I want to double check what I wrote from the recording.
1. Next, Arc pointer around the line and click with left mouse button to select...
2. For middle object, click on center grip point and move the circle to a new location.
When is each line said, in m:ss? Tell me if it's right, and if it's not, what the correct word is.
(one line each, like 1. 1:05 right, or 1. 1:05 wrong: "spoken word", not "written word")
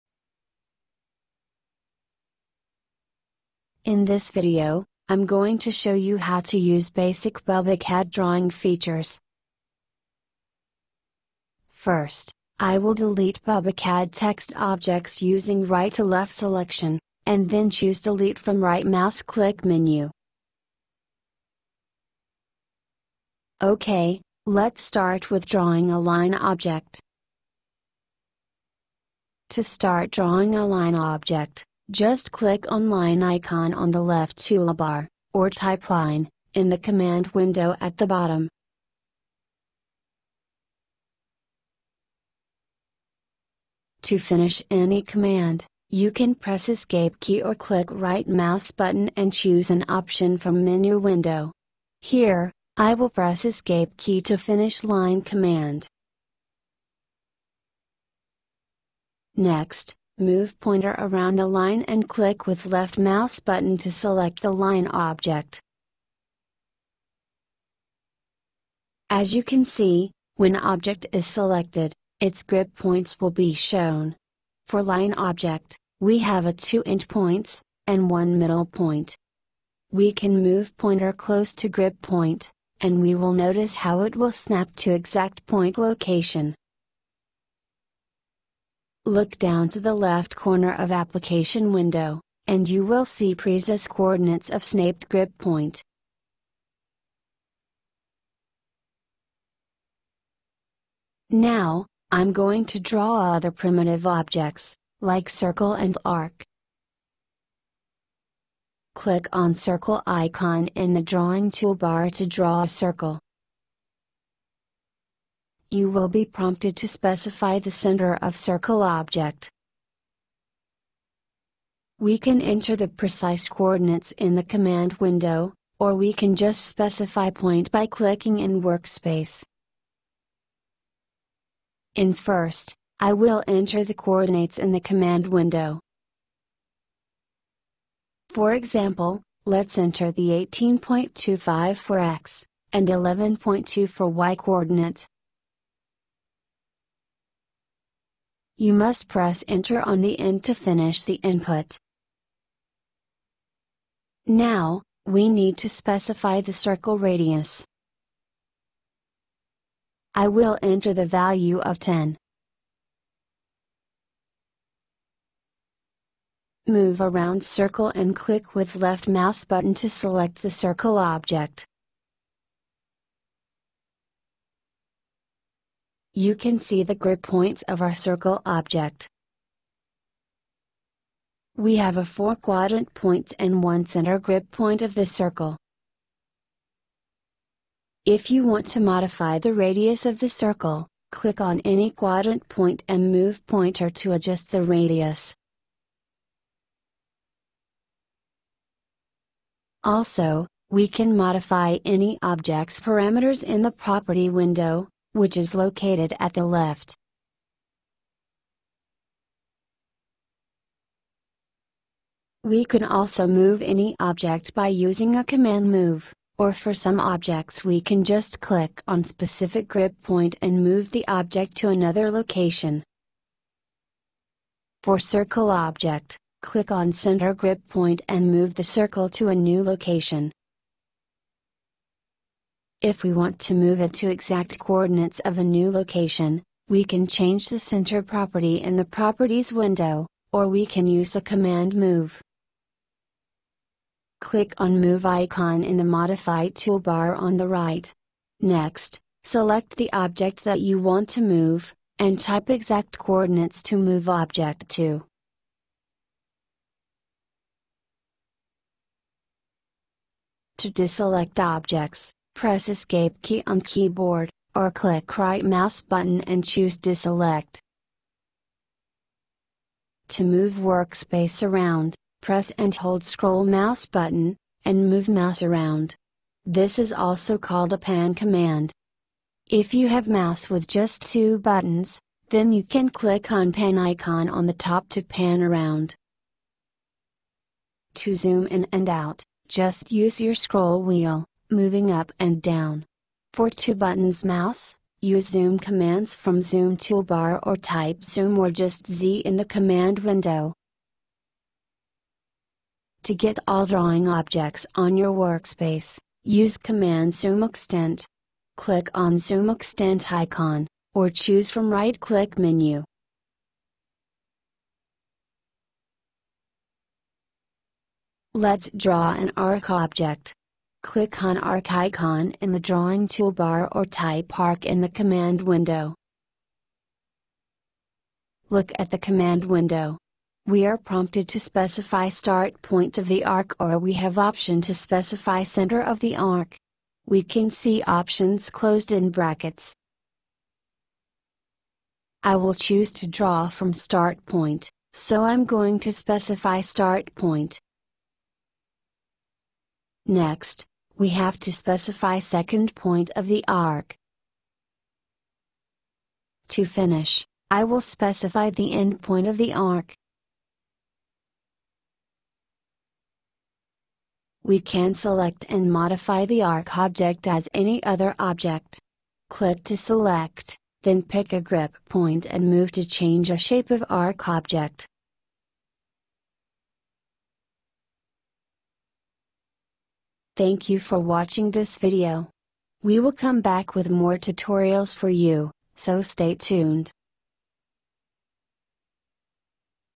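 1. 0:59 wrong: "Move", not "Arc"
2. 3:44 wrong: "circle", not "middle".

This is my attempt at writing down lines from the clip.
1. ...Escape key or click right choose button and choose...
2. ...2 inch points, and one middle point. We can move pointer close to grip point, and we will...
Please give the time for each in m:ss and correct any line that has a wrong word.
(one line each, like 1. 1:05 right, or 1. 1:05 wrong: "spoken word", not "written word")
1. 0:46 wrong: "mouse", not "choose"
2. 1:16 right.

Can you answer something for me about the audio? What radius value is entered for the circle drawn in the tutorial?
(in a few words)
10.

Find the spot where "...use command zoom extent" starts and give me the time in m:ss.
5:06.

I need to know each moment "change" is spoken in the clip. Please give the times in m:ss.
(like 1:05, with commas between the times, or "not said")
3:57, 6:12.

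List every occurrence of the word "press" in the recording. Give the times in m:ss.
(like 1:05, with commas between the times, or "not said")
0:46, 0:53, 2:29, 4:22, 4:32.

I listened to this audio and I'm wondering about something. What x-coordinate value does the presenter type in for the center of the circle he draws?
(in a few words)
18.25.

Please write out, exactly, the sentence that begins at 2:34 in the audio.
Now, we need to specify the circle radius.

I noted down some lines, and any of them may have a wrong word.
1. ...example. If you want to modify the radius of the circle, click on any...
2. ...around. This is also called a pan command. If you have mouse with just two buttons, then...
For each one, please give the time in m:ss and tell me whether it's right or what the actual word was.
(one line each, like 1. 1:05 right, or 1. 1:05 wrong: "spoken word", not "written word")
1. 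3:05 wrong: "circle", not "example"
2. 4:35 right.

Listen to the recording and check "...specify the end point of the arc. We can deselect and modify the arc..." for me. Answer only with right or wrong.
wrong.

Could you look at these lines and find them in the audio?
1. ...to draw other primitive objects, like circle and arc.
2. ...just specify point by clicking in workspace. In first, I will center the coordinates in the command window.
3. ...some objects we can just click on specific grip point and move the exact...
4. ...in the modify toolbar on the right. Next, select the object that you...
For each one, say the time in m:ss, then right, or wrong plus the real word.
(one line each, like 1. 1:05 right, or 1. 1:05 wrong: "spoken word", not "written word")
1. 1:42 right
2. 2:06 wrong: "enter", not "center"
3. 3:36 wrong: "object", not "exact"
4. 4:05 right.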